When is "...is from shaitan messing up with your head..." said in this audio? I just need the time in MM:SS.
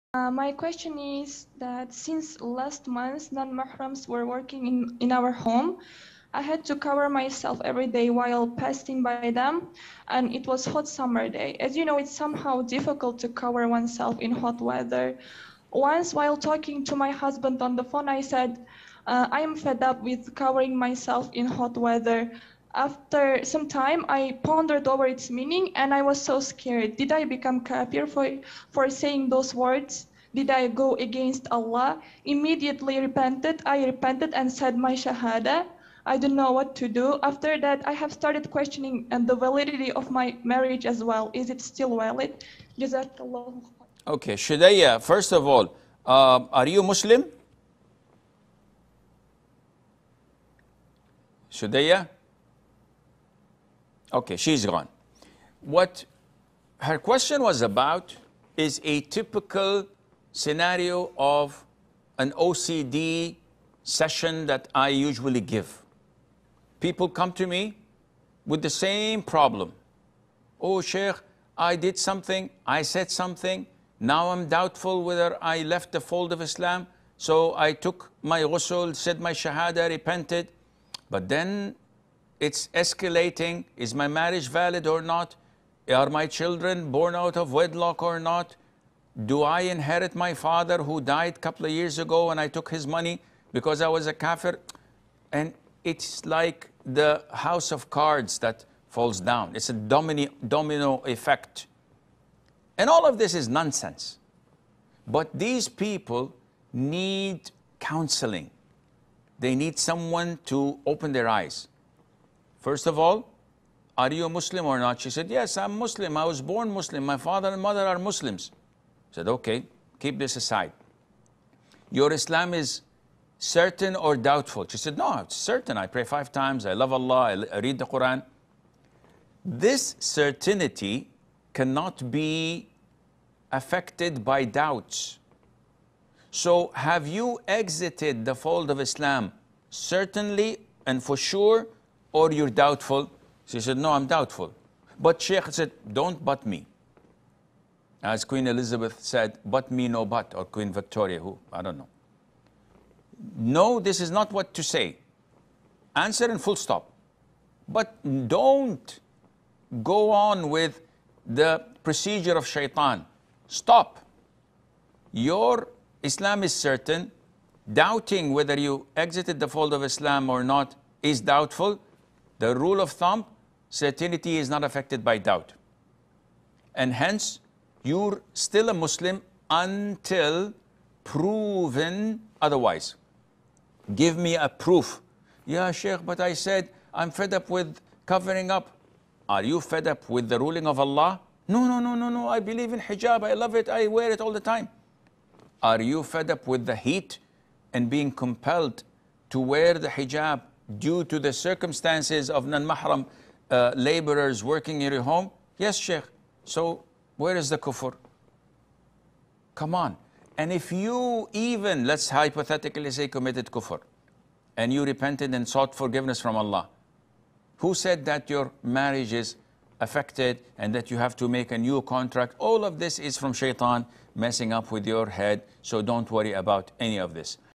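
03:42.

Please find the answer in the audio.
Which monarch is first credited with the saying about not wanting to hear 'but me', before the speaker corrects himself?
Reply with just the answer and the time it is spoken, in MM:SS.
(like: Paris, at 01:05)
Queen Elizabeth, at 02:28.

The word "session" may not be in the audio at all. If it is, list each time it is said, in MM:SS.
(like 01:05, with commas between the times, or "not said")
01:03.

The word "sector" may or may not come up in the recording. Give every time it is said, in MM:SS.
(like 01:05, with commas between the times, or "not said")
not said.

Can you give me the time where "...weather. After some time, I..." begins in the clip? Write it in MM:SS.
00:21.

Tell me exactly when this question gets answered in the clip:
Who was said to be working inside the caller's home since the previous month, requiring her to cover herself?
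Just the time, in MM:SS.
00:03.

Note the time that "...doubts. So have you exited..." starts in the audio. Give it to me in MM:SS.
02:14.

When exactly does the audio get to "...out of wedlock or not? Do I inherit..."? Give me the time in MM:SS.
01:27.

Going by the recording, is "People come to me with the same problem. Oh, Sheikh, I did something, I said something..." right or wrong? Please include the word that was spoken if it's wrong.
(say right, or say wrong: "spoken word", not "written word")
right.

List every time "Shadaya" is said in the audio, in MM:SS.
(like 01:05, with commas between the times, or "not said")
00:44, 00:51.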